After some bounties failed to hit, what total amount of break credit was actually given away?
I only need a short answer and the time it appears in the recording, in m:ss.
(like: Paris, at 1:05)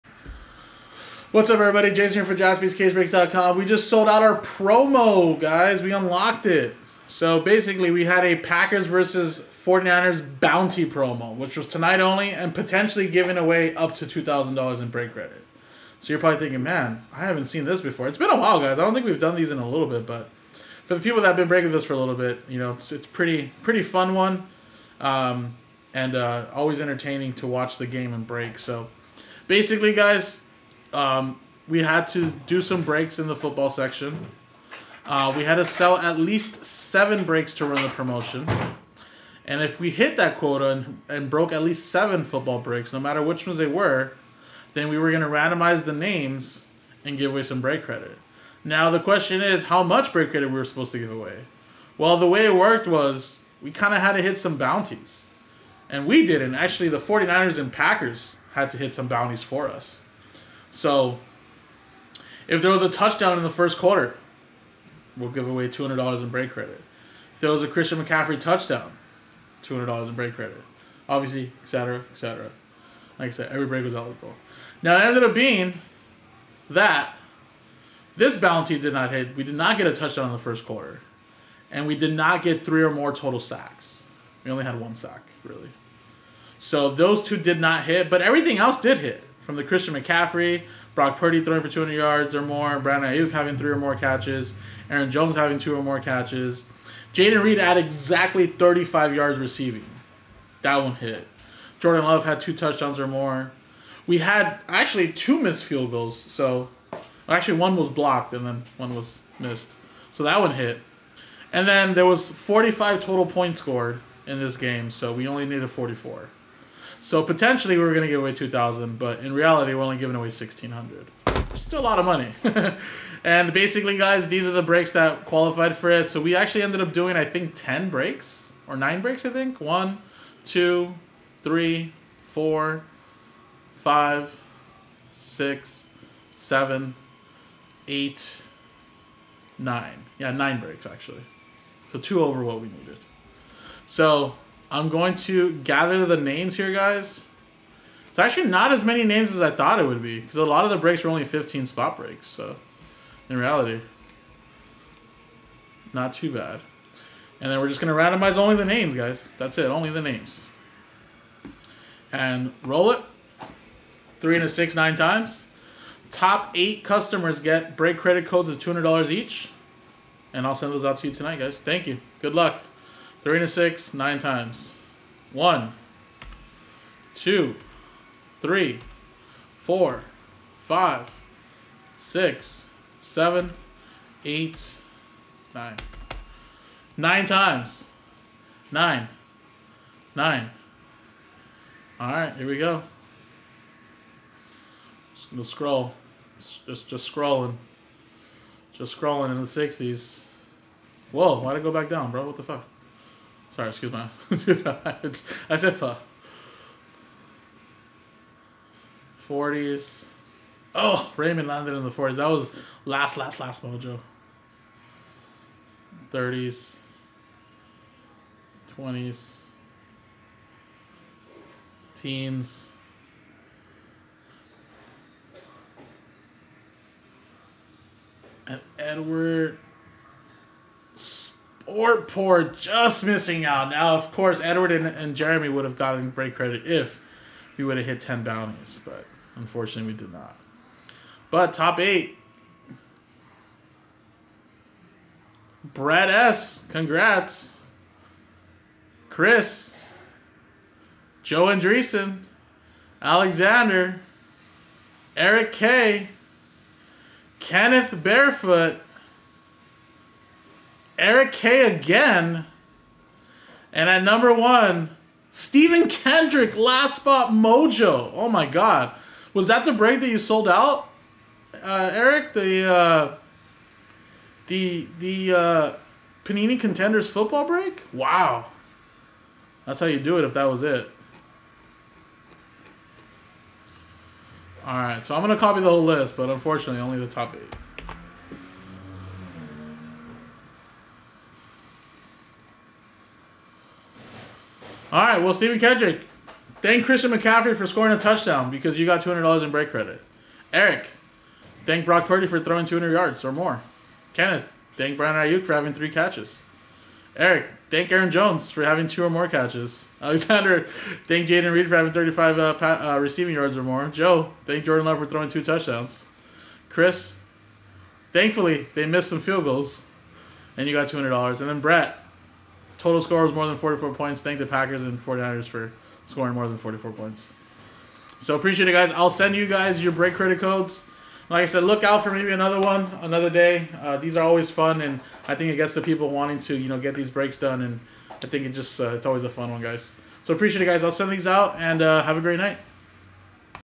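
$1,600, at 2:00.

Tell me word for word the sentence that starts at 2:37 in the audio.
And then we're just going to randomize only the names, guys.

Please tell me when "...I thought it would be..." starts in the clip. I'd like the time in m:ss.
2:29.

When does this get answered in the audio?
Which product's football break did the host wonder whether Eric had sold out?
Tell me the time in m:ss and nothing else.
4:36.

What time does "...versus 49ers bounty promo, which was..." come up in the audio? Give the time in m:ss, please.
0:08.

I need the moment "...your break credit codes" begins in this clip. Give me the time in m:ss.
5:29.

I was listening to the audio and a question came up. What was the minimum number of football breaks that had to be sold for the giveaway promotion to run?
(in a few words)
7.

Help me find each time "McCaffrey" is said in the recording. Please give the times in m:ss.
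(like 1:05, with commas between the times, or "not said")
1:08, 1:29, 4:57.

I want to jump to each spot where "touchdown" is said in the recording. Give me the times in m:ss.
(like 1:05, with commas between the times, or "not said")
1:02, 1:08, 1:19, 1:42, 4:57, 5:15.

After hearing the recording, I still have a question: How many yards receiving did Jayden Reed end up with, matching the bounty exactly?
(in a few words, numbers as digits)
35.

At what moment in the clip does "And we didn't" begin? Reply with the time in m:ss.
0:55.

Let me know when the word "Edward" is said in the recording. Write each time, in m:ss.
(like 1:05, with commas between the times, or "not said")
3:48, 3:54.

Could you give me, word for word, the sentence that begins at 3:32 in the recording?
That was last, last, last mojo.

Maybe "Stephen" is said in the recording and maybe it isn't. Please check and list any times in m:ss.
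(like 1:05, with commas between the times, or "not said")
4:25, 4:55.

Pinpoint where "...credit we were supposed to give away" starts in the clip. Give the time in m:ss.
0:50.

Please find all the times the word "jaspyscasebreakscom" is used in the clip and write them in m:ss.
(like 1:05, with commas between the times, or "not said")
0:02.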